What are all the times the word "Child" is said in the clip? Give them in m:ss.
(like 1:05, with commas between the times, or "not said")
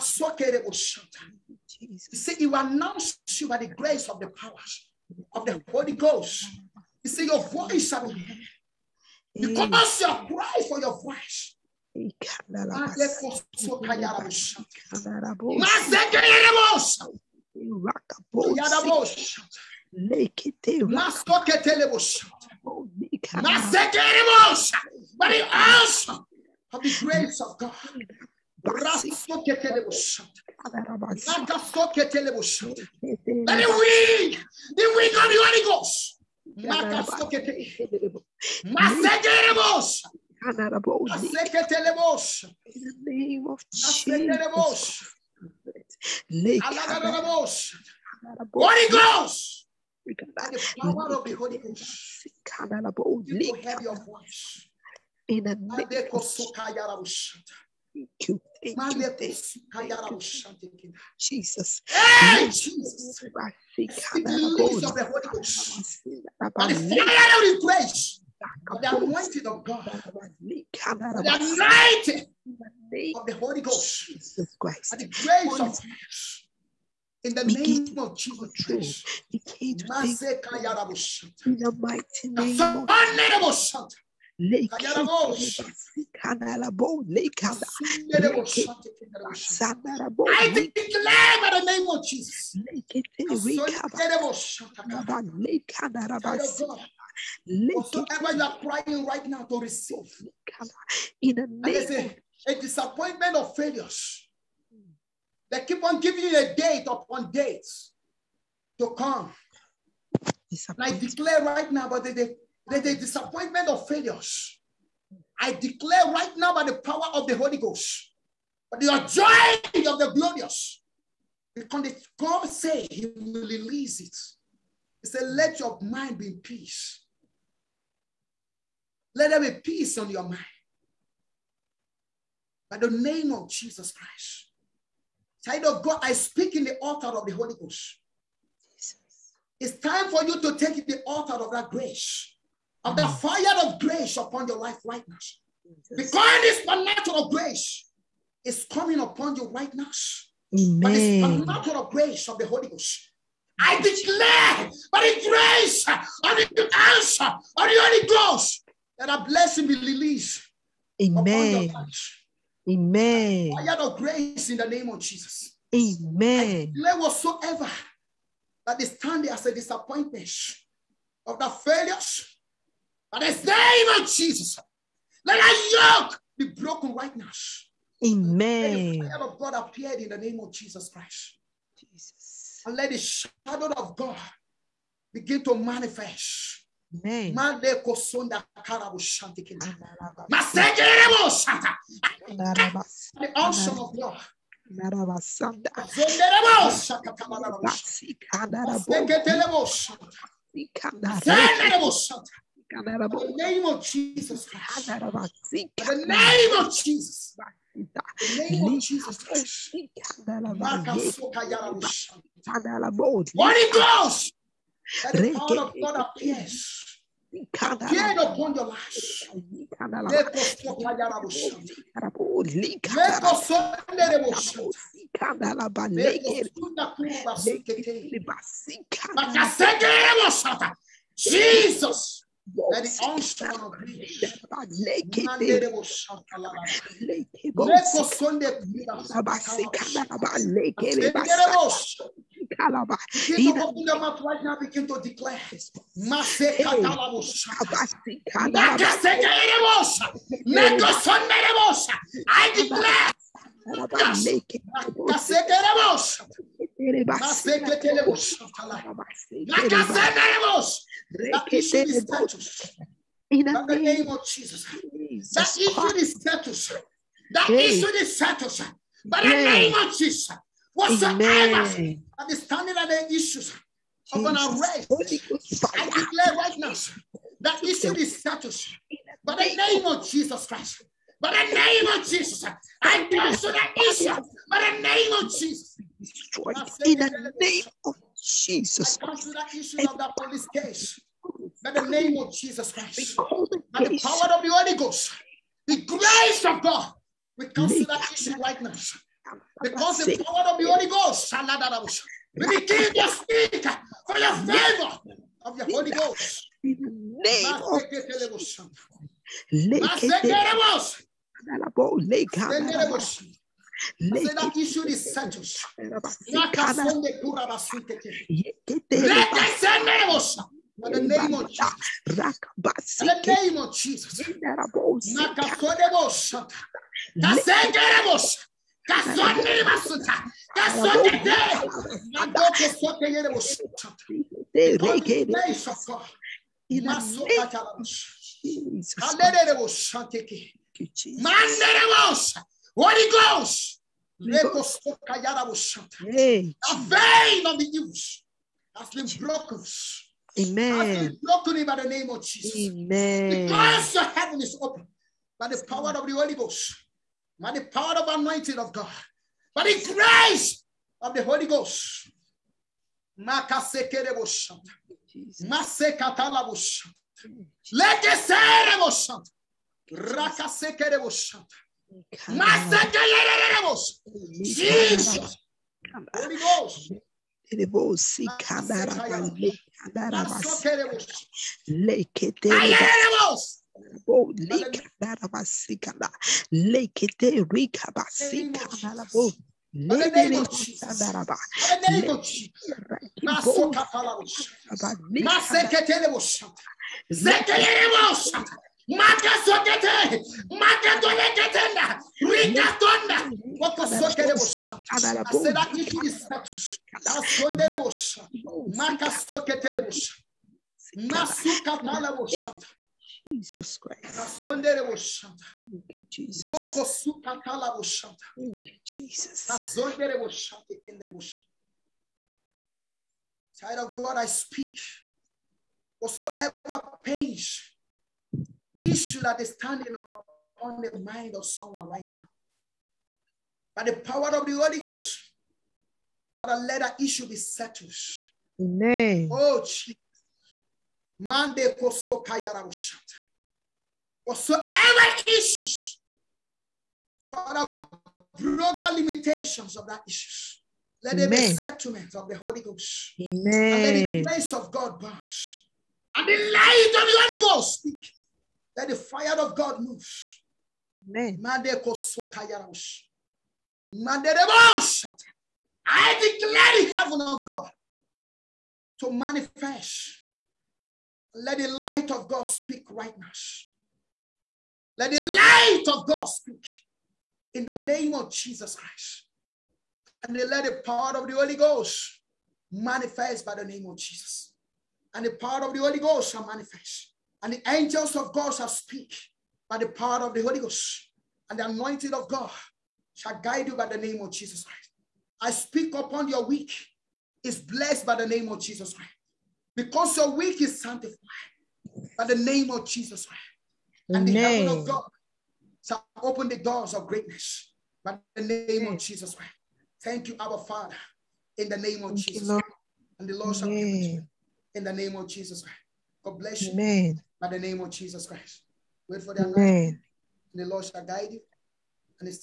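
2:15, 7:03.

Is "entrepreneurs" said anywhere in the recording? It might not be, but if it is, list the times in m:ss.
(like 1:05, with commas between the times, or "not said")
not said.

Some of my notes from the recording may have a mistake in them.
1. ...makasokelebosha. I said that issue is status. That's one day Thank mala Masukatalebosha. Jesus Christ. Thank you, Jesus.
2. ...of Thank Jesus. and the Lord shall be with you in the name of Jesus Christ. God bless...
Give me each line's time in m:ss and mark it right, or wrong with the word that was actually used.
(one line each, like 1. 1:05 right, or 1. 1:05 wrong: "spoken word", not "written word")
1. 6:43 wrong: "Masuka", not "Thank"
2. 8:32 right.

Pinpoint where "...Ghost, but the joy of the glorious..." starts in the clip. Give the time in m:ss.
1:57.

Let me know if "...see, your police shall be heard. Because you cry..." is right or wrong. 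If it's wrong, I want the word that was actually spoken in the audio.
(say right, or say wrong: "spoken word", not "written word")
wrong: "voice", not "police".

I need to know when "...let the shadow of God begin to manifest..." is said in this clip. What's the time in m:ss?
3:02.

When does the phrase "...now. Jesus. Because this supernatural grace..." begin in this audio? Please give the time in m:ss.
2:25.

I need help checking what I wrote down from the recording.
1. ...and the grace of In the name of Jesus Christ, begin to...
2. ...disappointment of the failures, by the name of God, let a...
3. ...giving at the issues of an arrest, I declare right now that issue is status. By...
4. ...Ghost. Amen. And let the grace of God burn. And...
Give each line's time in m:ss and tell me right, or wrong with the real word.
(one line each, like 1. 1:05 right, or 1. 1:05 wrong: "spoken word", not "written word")
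1. 1:14 right
2. 2:49 wrong: "Jesus", not "God"
3. 4:32 wrong: "standing", not "giving"
4. 7:32 right.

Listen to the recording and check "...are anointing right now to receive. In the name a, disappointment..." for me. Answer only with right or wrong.
wrong.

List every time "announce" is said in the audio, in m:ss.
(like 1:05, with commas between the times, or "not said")
0:02.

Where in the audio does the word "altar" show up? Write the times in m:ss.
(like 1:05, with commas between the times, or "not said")
2:16, 2:21.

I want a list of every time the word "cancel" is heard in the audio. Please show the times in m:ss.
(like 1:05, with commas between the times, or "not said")
4:43, 4:49, 4:57.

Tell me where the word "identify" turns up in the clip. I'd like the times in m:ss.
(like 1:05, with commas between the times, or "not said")
not said.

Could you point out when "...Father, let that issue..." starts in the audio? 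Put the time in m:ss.
7:16.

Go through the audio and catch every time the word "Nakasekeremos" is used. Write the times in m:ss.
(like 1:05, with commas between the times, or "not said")
4:13, 4:19.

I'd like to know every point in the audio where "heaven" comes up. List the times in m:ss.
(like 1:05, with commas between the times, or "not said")
5:54, 7:46, 8:24.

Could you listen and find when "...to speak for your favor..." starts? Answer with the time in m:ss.
5:02.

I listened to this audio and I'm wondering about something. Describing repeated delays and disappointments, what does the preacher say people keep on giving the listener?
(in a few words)
a date upon dates.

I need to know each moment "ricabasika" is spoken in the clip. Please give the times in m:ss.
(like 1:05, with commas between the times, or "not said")
6:27.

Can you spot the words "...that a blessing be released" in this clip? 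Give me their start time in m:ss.
2:38.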